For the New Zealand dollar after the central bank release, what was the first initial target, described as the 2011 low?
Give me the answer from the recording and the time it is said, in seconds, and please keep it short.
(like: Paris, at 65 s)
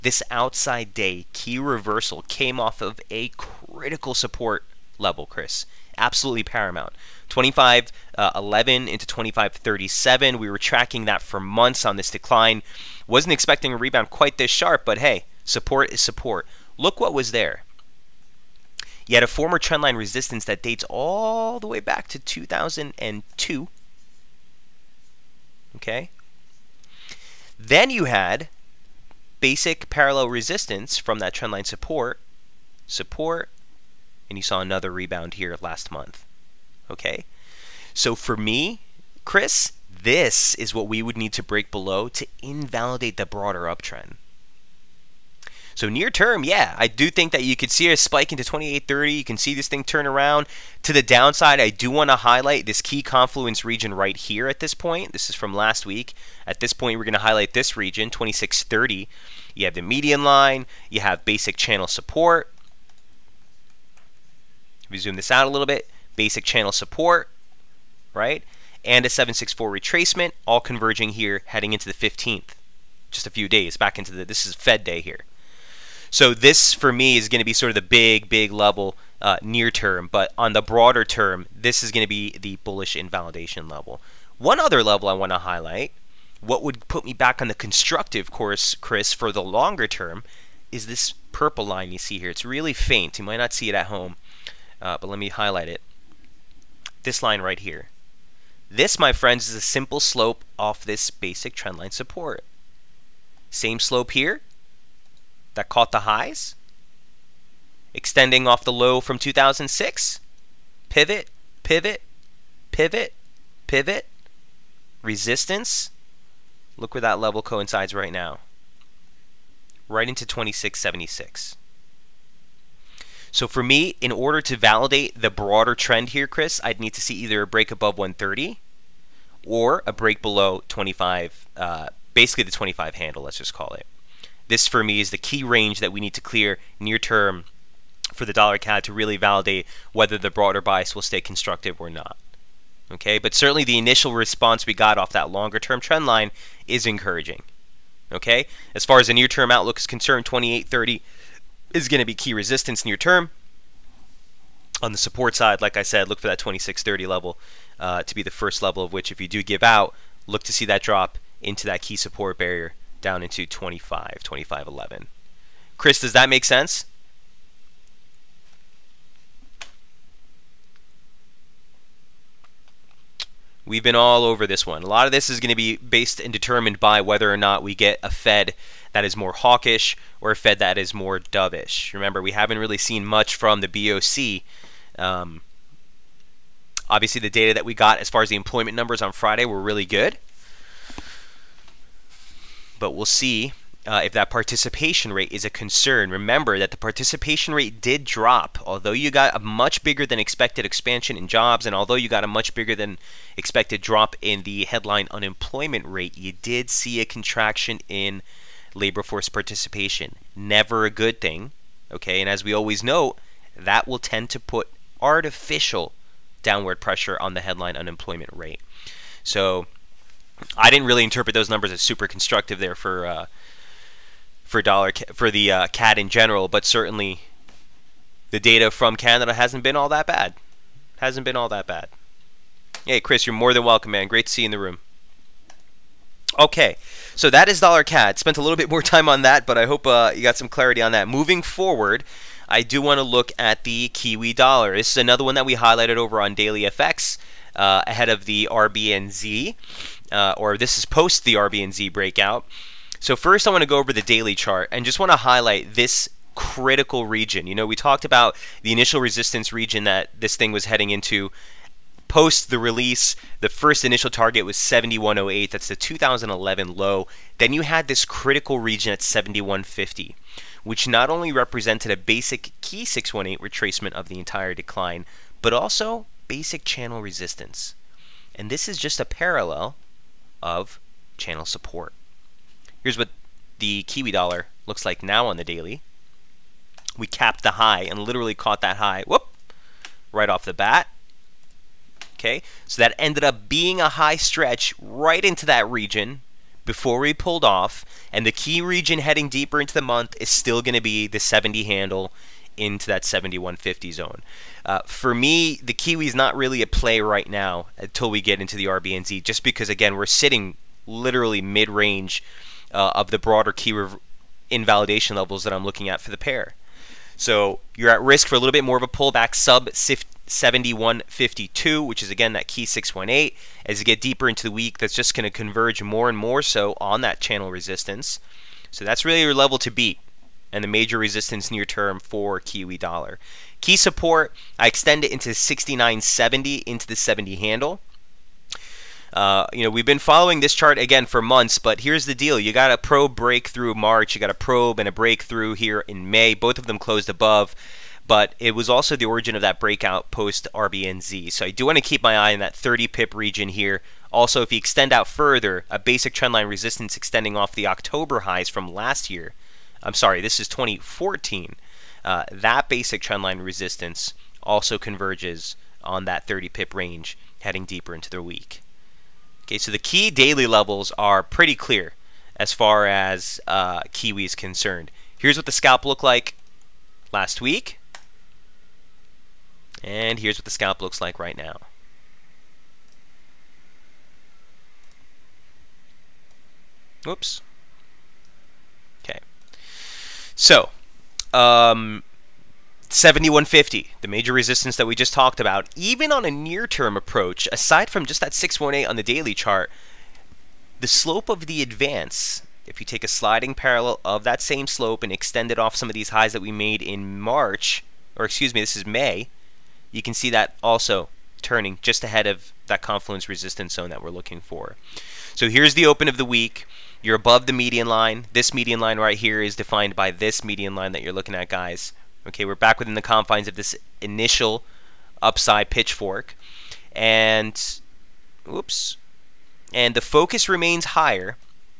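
7108, at 264 s.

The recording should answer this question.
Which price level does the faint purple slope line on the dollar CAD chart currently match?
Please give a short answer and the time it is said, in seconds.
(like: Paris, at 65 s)
2676, at 120 s.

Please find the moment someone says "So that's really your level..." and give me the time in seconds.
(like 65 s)
328 s.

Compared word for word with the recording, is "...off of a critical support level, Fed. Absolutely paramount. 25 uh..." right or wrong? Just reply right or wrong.
wrong.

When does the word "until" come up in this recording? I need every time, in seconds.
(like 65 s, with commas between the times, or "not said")
307 s.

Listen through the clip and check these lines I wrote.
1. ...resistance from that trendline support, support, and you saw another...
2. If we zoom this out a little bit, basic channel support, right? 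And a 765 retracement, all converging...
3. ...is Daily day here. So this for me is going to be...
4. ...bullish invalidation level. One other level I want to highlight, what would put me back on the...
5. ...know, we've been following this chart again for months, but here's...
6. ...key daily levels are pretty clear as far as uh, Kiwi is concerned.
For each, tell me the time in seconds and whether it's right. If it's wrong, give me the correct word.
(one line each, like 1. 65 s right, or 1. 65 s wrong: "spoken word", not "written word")
1. 30 s right
2. 64 s wrong: "764", not "765"
3. 74 s wrong: "Fed", not "Daily"
4. 82 s right
5. 339 s right
6. 369 s right.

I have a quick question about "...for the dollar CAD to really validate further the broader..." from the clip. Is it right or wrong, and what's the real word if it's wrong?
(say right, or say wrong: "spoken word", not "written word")
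wrong: "whether", not "further".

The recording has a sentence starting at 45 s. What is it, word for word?
So near term, yeah, I do think that you could see a spike into 2830.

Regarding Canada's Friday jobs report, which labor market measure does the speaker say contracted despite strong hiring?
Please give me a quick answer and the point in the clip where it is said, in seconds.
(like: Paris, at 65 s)
labor force participation, at 208 s.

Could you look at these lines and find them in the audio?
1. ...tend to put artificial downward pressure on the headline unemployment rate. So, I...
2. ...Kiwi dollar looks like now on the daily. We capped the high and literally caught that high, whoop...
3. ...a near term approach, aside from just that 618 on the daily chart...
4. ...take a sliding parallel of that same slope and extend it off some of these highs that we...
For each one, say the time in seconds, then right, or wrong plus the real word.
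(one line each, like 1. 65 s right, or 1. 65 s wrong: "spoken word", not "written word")
1. 213 s right
2. 283 s right
3. 396 s right
4. 402 s right.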